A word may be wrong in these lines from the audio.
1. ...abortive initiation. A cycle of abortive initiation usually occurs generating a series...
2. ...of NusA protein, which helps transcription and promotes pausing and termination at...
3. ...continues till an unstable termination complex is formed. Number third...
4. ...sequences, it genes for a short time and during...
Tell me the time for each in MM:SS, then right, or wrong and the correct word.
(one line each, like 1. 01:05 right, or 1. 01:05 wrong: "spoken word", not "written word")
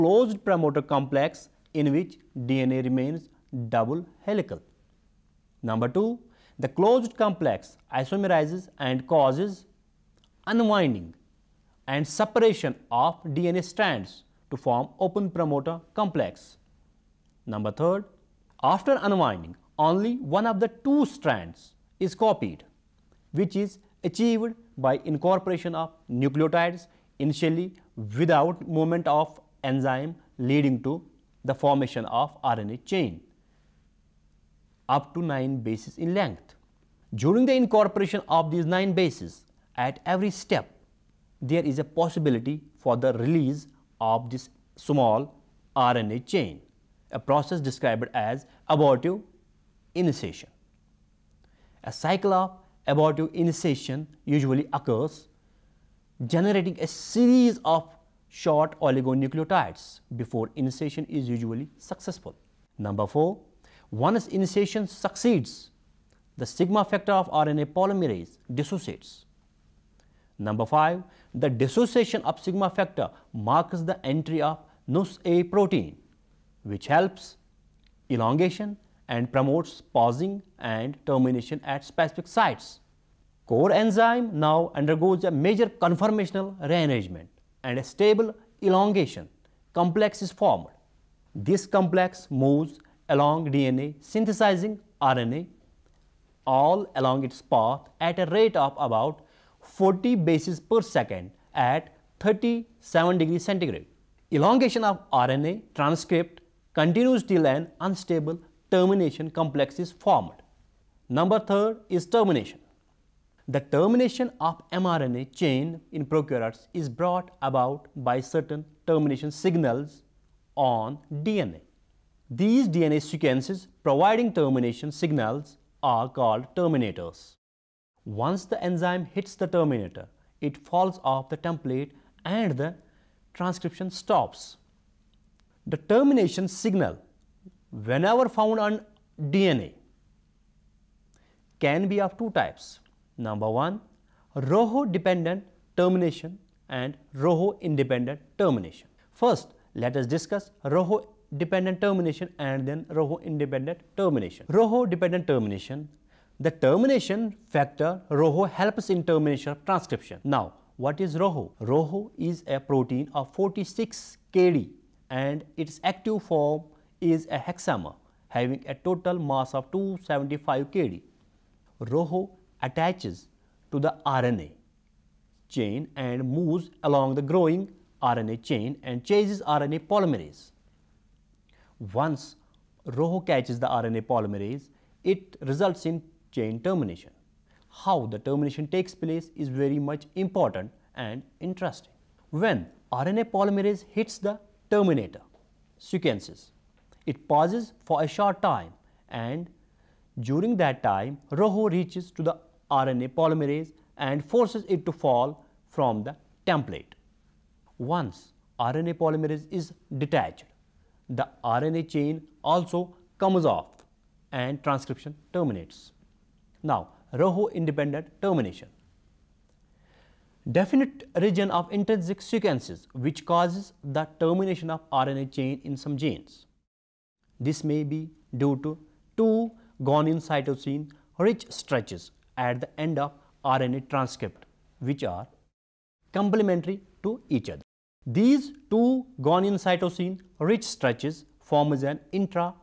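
1. 00:48 right
2. 01:14 wrong: "elongation", not "transcription"
3. 01:46 right
4. 03:15 wrong: "pauses", not "genes".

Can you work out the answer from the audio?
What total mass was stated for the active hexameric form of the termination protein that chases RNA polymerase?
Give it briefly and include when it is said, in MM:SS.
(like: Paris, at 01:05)
275 kD, at 02:49.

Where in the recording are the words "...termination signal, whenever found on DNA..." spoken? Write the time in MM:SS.
02:15.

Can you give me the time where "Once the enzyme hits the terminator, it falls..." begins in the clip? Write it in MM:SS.
02:08.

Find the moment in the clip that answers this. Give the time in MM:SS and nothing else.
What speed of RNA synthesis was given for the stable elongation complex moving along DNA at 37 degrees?
01:39.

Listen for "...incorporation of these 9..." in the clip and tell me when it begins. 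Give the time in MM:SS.
00:37.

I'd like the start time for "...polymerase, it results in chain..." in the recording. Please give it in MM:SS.
03:04.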